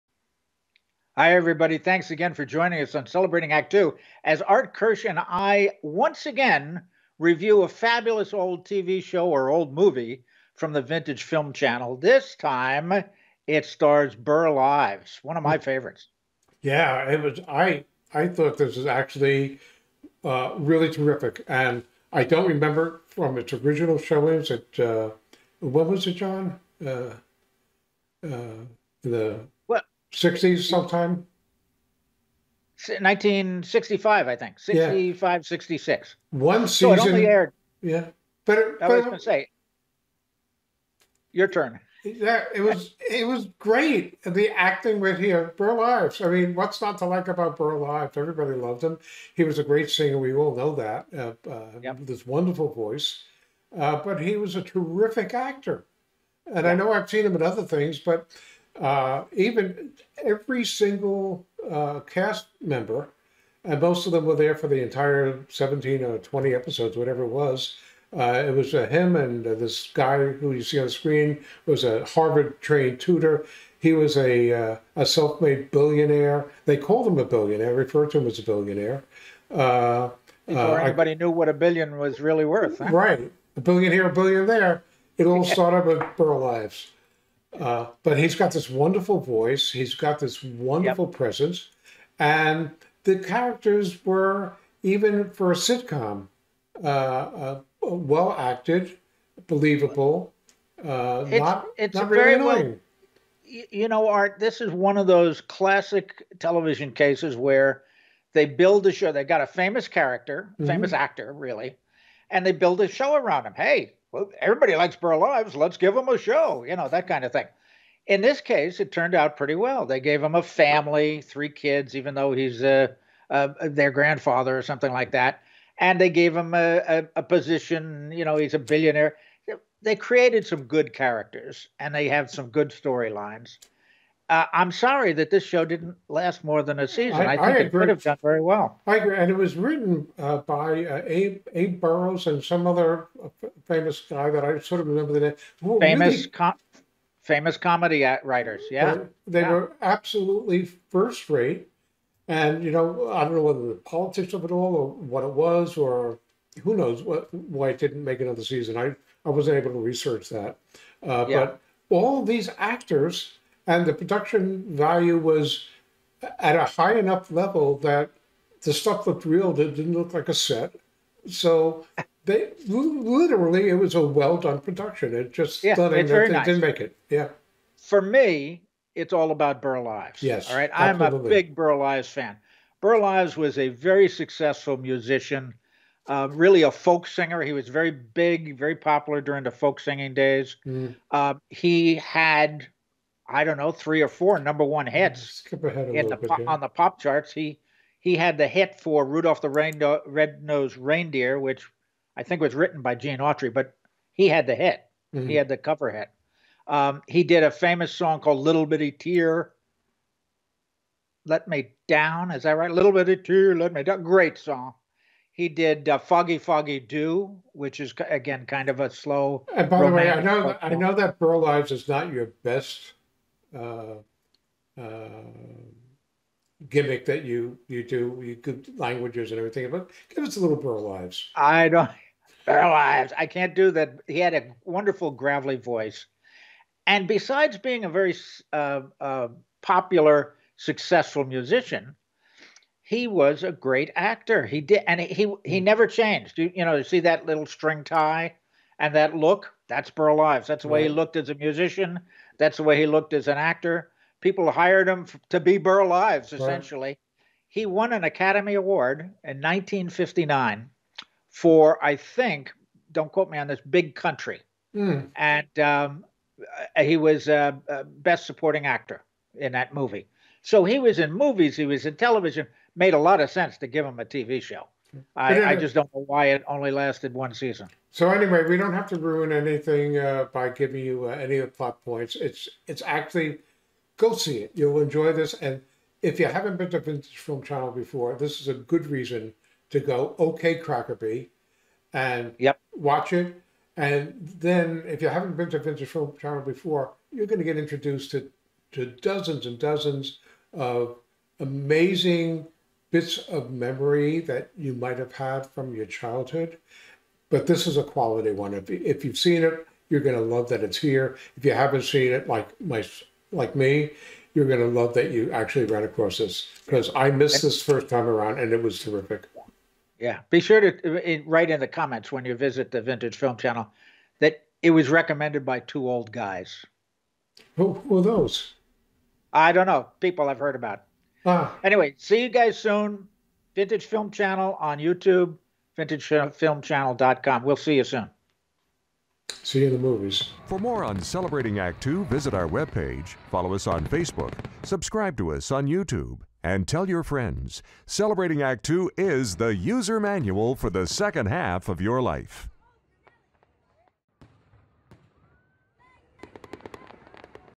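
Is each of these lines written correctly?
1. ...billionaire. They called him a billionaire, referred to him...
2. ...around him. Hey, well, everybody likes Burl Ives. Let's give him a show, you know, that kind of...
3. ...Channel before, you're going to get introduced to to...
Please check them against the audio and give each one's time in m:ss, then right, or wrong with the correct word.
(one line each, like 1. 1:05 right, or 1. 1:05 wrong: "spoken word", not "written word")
1. 1:15 right
2. 1:53 right
3. 4:56 right.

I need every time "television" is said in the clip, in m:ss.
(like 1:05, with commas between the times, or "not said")
1:46, 4:31.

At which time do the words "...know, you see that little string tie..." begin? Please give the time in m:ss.
4:06.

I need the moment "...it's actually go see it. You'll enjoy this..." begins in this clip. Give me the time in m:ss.
4:42.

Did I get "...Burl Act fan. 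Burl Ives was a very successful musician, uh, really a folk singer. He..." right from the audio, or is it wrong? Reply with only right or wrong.
wrong.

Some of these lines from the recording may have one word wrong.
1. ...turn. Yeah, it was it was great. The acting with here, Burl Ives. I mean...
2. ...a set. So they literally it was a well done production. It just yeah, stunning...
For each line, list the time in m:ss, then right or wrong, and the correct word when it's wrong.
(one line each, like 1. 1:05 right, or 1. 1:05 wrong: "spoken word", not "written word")
1. 0:41 right
2. 2:50 right.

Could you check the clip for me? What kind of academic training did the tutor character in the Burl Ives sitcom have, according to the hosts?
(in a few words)
Harvard-trained.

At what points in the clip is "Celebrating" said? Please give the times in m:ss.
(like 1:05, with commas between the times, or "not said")
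0:03, 5:41, 5:47.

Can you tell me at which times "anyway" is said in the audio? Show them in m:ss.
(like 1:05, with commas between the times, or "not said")
4:38, 5:31.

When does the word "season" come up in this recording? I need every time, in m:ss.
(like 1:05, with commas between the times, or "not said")
0:36, 2:16, 2:38, 4:37.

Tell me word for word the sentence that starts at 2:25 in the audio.
Well, famous, really, com- famous comedy writers.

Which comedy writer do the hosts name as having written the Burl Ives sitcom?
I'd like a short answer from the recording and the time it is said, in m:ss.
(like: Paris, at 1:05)
Abe Burrows, at 2:21.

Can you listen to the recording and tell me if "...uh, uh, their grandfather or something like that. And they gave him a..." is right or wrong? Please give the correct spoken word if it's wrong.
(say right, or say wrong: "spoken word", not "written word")
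right.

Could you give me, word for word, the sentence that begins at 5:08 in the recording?
If, if you've seen it, you're going to love that it's here.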